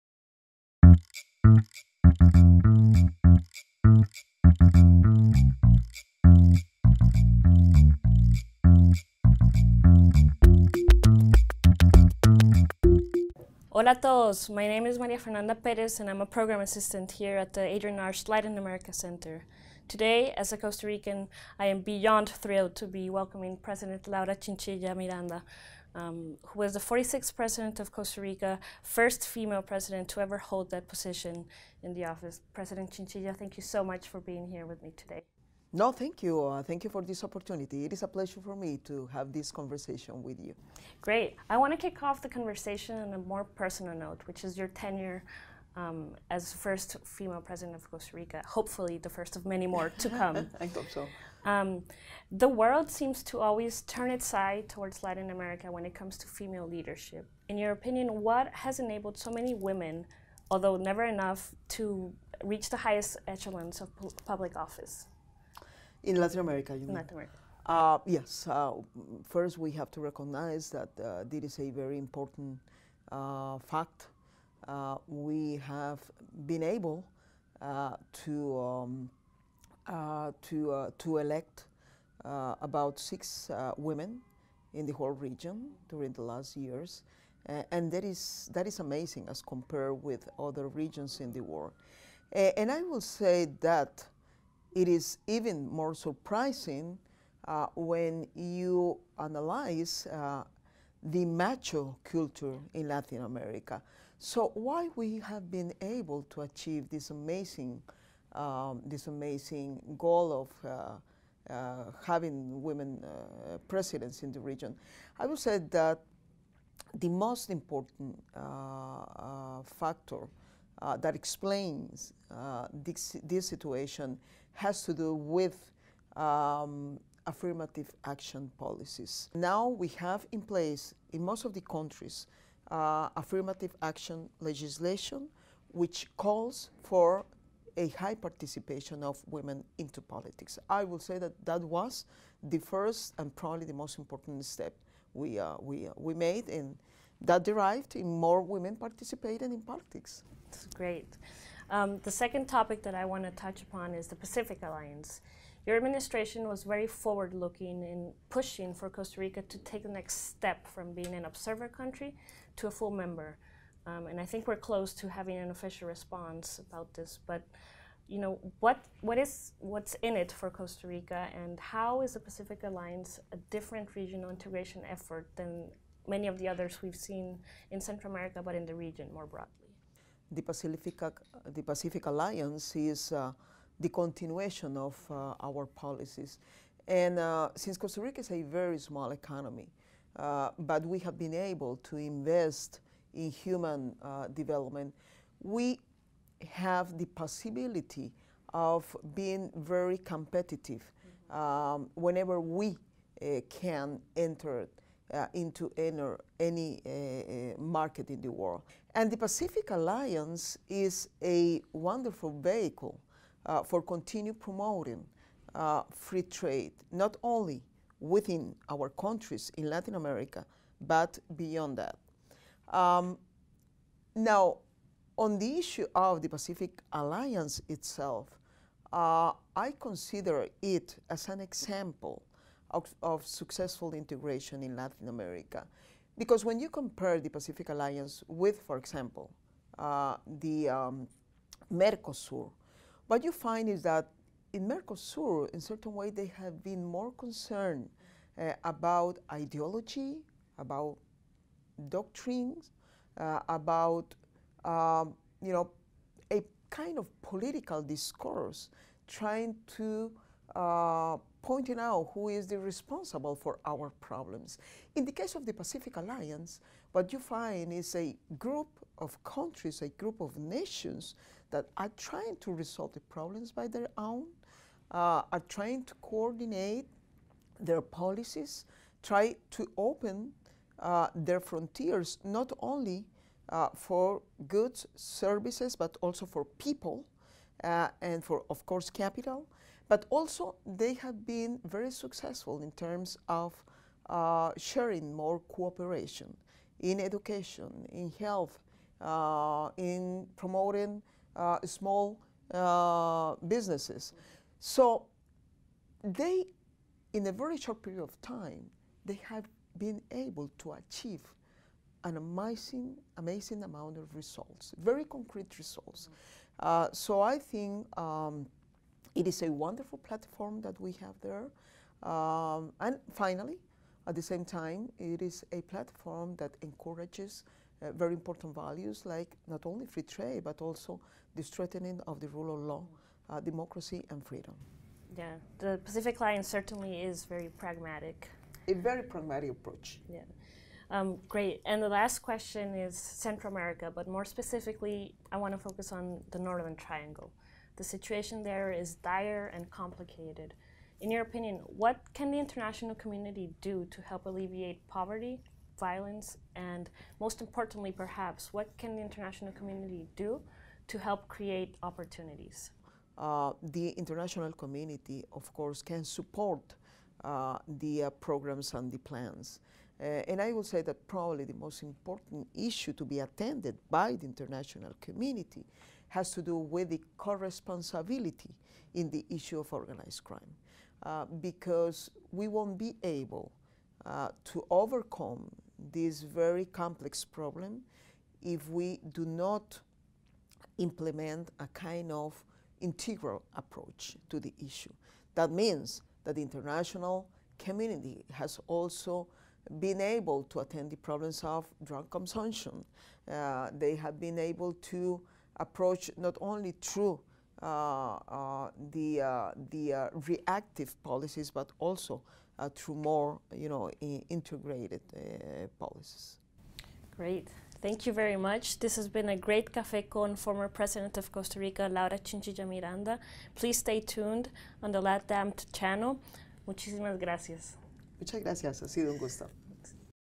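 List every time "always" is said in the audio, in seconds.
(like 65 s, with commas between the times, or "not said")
53 s.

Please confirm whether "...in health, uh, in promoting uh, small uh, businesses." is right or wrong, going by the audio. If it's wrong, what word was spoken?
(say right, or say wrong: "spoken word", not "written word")
right.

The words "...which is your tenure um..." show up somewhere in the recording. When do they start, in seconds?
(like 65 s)
44 s.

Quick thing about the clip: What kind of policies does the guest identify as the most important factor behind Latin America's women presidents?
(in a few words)
Affirmative action policies.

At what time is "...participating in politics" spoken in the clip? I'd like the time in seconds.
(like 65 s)
148 s.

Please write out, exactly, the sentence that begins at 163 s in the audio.
Um, and I think we're close to having an official response about this.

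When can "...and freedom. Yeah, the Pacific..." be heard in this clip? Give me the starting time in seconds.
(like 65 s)
334 s.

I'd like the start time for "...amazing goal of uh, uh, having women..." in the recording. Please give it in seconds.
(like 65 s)
109 s.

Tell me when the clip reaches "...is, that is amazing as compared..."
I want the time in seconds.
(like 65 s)
88 s.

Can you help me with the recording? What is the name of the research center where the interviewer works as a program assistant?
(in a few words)
Adrienne Arsht Latin America Center.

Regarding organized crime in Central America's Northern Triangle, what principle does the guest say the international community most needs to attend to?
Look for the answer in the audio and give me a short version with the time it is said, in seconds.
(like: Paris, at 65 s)
Co-responsibility, at 377 s.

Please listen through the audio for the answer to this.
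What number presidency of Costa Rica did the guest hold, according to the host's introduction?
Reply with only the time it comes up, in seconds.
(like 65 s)
26 s.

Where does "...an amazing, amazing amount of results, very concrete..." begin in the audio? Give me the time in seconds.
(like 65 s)
312 s.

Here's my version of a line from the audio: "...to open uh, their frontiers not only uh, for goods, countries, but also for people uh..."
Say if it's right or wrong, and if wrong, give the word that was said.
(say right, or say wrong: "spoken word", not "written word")
wrong: "services", not "countries".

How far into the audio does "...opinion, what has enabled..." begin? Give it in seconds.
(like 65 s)
57 s.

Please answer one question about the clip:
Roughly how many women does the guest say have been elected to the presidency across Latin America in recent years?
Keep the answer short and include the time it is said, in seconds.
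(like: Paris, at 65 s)
6, at 82 s.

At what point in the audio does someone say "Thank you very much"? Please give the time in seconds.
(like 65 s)
417 s.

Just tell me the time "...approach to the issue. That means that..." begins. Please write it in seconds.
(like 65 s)
393 s.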